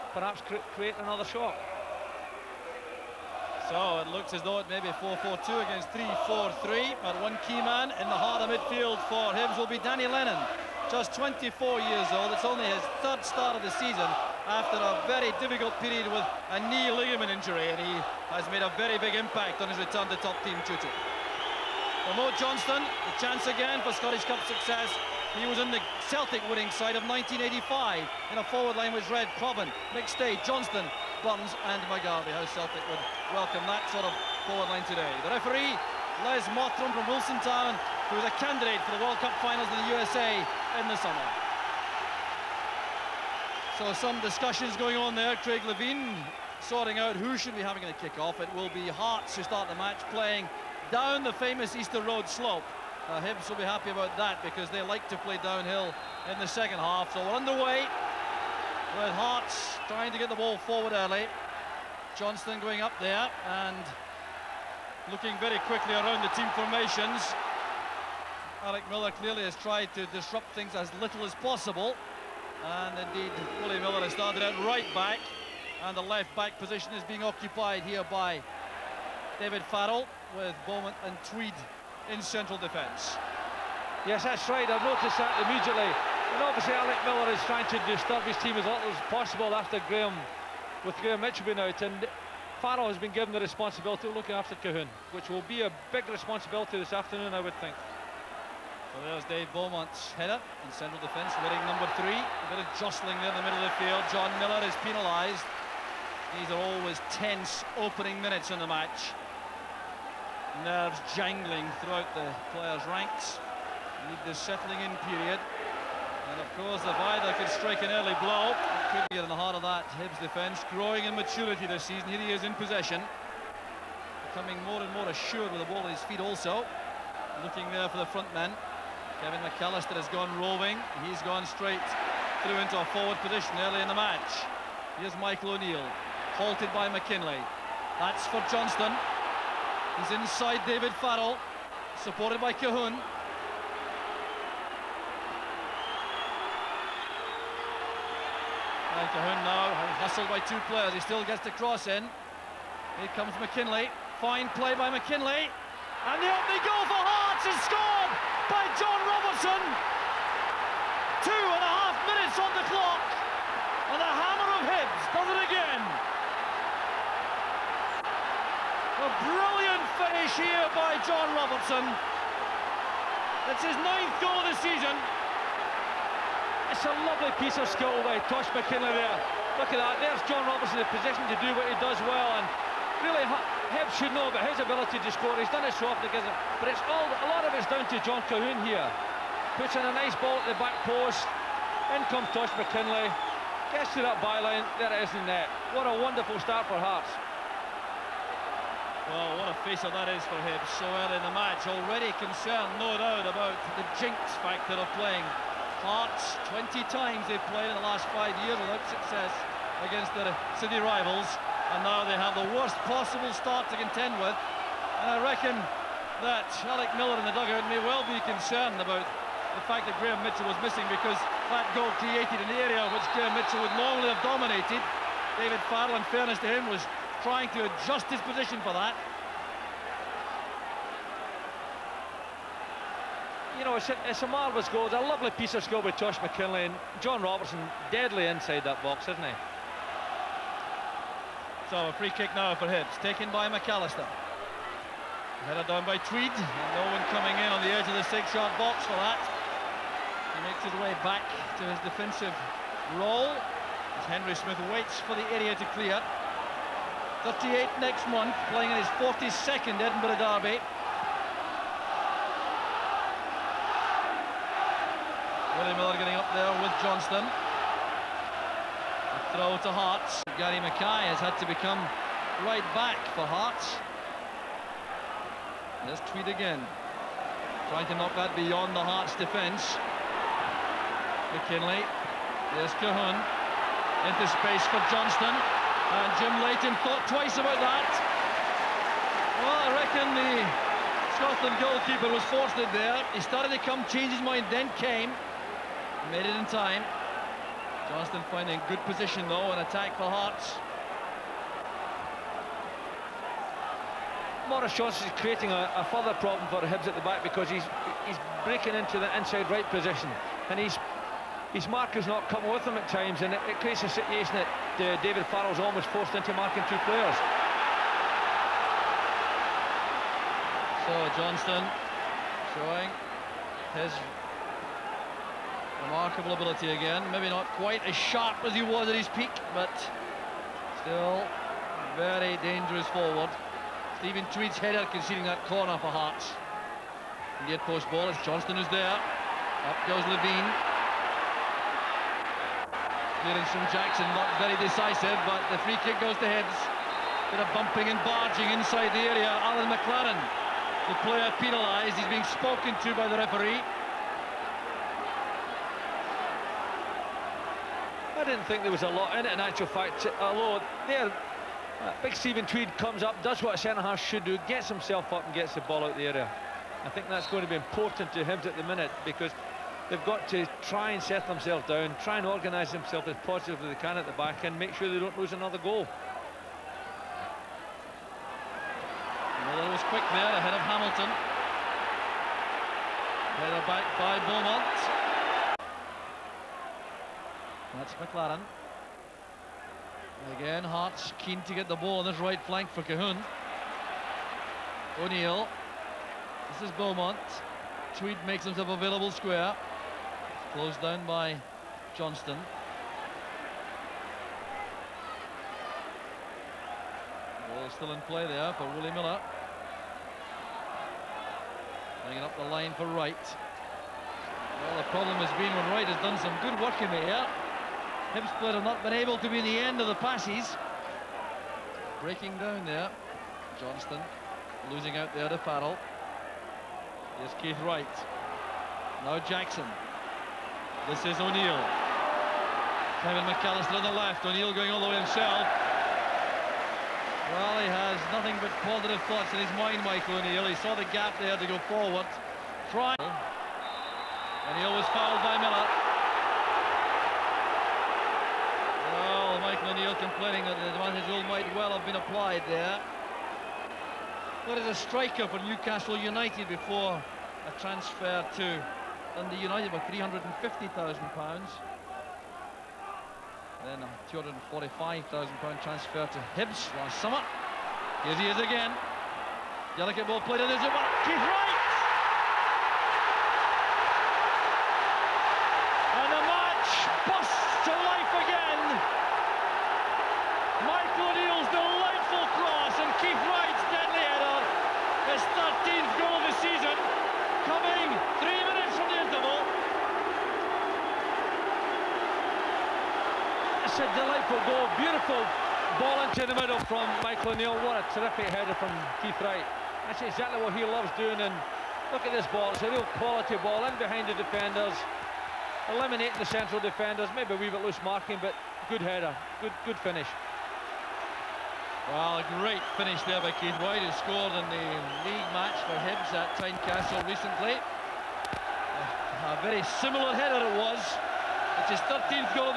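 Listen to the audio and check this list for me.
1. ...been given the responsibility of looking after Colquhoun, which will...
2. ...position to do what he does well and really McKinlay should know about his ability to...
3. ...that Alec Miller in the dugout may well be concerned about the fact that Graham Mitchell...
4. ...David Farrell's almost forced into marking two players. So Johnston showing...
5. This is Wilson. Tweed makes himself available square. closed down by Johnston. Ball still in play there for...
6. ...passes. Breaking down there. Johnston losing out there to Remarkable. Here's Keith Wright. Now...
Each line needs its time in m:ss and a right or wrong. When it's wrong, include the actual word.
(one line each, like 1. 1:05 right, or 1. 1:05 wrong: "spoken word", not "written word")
1. 1:32 right
2. 3:00 wrong: "Hibs", not "McKinlay"
3. 3:36 right
4. 5:15 right
5. 6:36 wrong: "Beaumont", not "Wilson"
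6. 6:59 wrong: "Farrell", not "Remarkable".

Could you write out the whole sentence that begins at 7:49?
Delicate ball played, and there's it back.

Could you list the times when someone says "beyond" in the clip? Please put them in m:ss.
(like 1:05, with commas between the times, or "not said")
4:38.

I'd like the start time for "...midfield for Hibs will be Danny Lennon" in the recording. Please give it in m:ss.
0:08.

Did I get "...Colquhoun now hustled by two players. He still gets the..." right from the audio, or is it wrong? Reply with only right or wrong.
right.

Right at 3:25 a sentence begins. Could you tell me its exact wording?
Hearts, 20 times they've played in the last five years without success against their city rivals.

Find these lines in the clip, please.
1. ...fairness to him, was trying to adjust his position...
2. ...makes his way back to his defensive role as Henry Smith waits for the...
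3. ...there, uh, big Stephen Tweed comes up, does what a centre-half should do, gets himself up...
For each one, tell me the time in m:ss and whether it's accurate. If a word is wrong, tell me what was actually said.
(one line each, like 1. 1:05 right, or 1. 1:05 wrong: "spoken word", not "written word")
1. 3:46 right
2. 4:10 right
3. 6:00 right.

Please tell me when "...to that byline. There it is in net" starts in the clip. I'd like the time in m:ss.
3:13.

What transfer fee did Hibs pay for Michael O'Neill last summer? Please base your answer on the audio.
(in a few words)
£245,000.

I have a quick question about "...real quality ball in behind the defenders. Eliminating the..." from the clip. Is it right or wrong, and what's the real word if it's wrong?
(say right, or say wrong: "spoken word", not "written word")
right.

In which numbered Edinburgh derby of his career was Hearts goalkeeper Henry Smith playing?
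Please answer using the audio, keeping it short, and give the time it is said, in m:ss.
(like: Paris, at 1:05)
42nd, at 4:18.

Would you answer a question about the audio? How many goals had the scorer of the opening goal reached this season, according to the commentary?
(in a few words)
9.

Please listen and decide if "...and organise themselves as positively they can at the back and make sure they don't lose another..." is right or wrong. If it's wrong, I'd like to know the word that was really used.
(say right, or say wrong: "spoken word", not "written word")
right.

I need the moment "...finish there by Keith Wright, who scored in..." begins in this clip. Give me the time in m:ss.
8:32.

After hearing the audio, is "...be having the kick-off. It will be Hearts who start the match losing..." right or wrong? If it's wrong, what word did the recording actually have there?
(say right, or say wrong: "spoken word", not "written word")
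wrong: "playing", not "losing".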